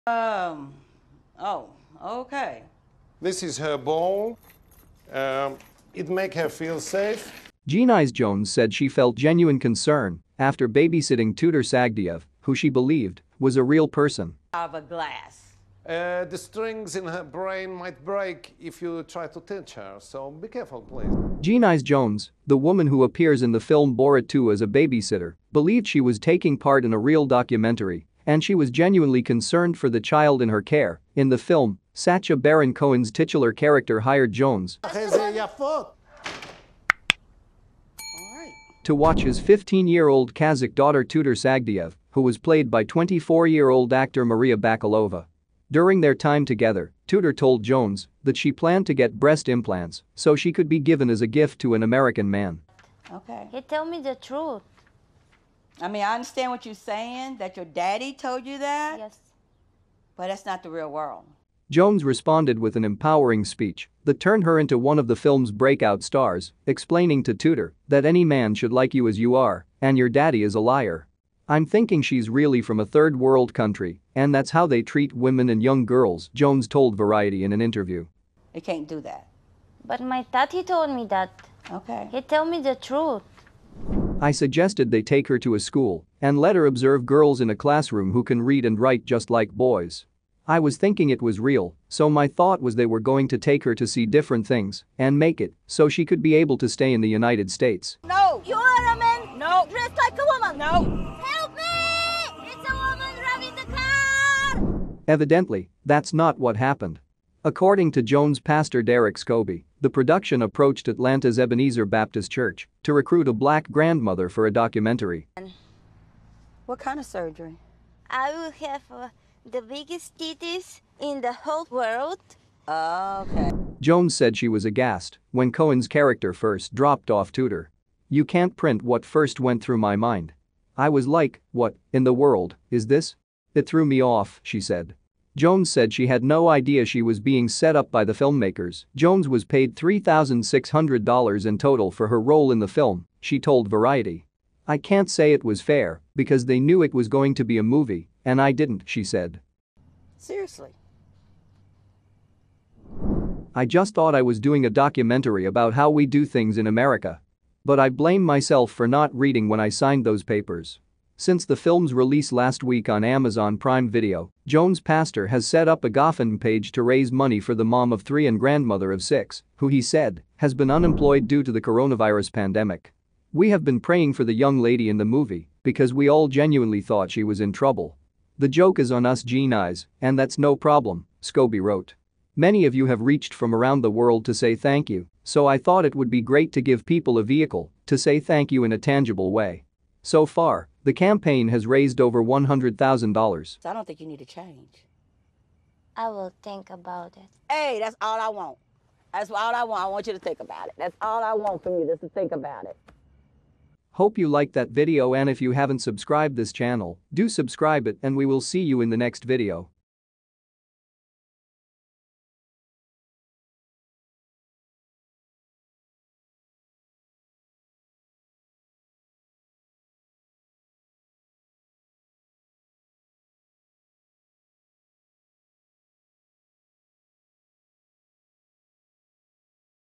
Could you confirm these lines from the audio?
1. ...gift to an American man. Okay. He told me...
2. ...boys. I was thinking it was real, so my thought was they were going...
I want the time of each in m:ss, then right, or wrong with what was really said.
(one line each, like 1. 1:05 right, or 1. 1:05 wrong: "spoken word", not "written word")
1. 0:51 right
2. 1:29 right.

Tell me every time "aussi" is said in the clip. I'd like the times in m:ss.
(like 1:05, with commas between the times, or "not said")
not said.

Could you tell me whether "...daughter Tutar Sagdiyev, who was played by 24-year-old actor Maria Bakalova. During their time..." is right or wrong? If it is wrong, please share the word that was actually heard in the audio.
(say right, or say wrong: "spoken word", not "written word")
right.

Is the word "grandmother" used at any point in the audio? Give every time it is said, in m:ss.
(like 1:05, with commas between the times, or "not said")
1:53, 2:48.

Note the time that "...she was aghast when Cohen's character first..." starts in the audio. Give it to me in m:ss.
2:04.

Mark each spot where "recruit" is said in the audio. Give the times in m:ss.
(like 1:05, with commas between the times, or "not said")
1:52.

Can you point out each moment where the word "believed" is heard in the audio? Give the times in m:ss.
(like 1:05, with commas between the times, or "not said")
0:12, 0:25.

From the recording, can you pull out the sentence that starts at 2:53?
We have been praying for the young lady in the movie because we all genuinely thought she was in trouble.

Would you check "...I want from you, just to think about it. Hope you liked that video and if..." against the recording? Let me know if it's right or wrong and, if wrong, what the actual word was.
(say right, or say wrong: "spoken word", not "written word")
right.